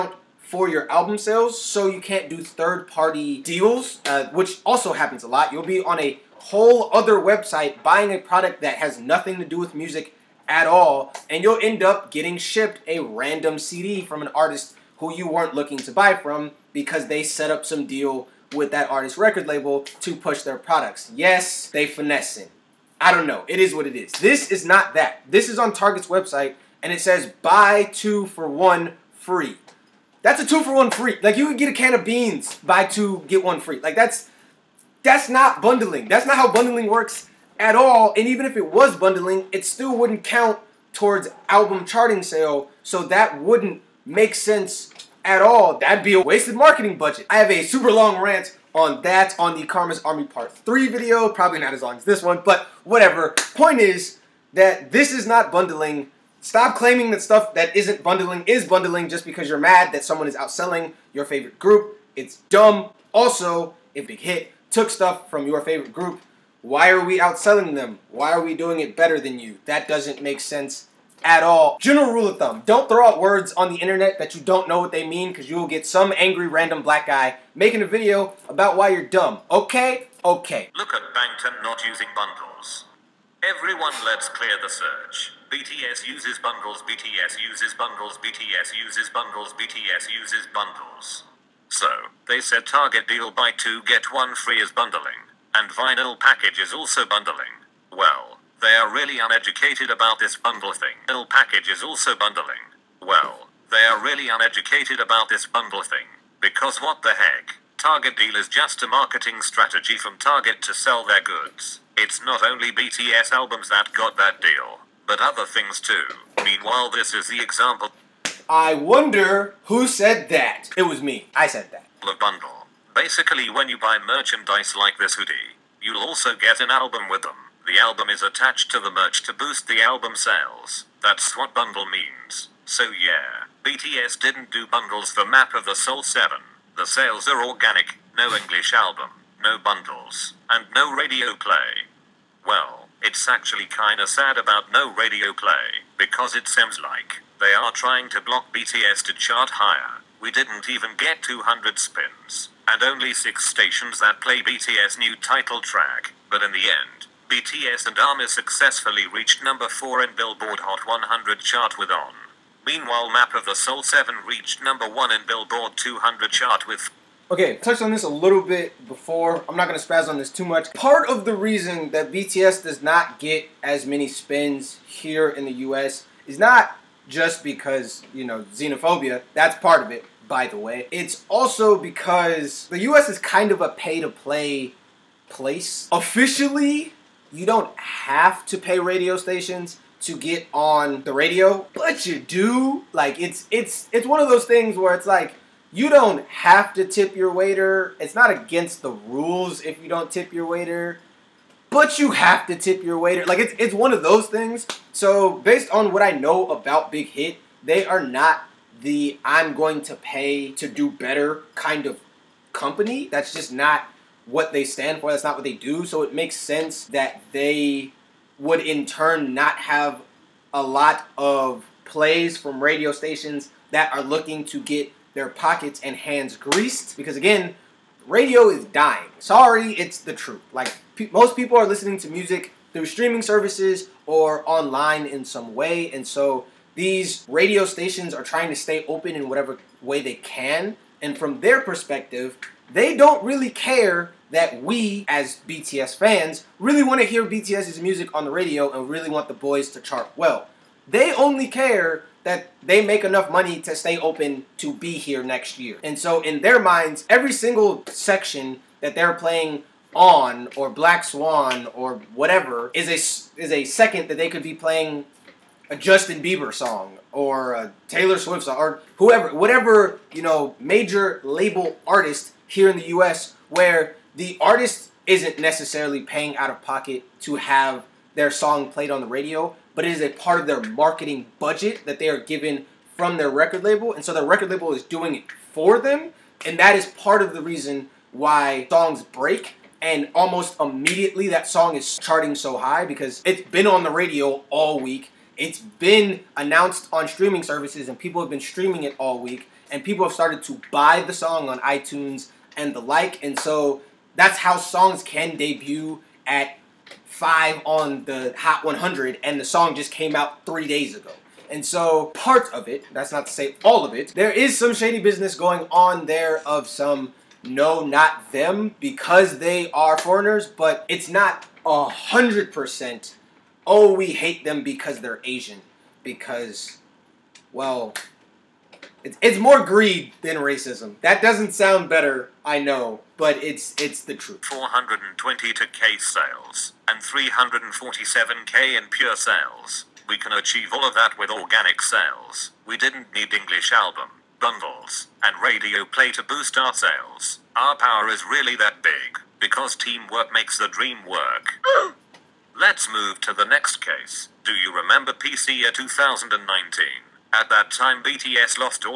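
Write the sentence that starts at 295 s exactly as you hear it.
It's been announced on streaming services and people have been streaming it all week.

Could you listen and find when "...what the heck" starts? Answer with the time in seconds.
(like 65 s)
106 s.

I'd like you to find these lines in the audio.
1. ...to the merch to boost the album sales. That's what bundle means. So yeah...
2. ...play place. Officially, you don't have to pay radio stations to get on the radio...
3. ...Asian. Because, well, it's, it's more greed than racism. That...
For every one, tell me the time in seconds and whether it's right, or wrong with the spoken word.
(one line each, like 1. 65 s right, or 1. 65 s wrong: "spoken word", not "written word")
1. 128 s right
2. 184 s right
3. 325 s right.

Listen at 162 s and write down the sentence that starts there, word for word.
Meanwhile Map of the Soul 7 reached number 1 in Billboard 200 chart with Okay, touched on this a little bit before.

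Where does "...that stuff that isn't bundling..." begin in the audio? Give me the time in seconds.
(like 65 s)
57 s.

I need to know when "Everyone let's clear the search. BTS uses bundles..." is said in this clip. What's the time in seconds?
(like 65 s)
83 s.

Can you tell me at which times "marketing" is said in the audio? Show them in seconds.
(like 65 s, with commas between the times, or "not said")
46 s, 108 s, 280 s.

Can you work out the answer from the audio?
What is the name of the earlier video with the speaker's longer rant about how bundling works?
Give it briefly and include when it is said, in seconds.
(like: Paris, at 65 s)
Karma's Army Part 3, at 49 s.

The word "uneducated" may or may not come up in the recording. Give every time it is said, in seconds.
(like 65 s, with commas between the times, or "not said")
99 s, 104 s.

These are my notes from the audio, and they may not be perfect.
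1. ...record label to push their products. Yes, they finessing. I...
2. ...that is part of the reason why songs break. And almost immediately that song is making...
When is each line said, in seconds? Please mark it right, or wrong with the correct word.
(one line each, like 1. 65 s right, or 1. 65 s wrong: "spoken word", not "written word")
1. 19 s right
2. 286 s wrong: "charting", not "making".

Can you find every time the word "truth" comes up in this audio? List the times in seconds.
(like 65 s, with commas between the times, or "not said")
230 s, 334 s.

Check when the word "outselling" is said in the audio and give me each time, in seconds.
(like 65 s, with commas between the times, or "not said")
60 s, 67 s.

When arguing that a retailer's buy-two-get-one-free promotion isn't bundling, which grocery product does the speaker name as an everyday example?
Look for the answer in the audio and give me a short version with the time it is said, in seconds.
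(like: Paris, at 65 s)
A can of beans, at 31 s.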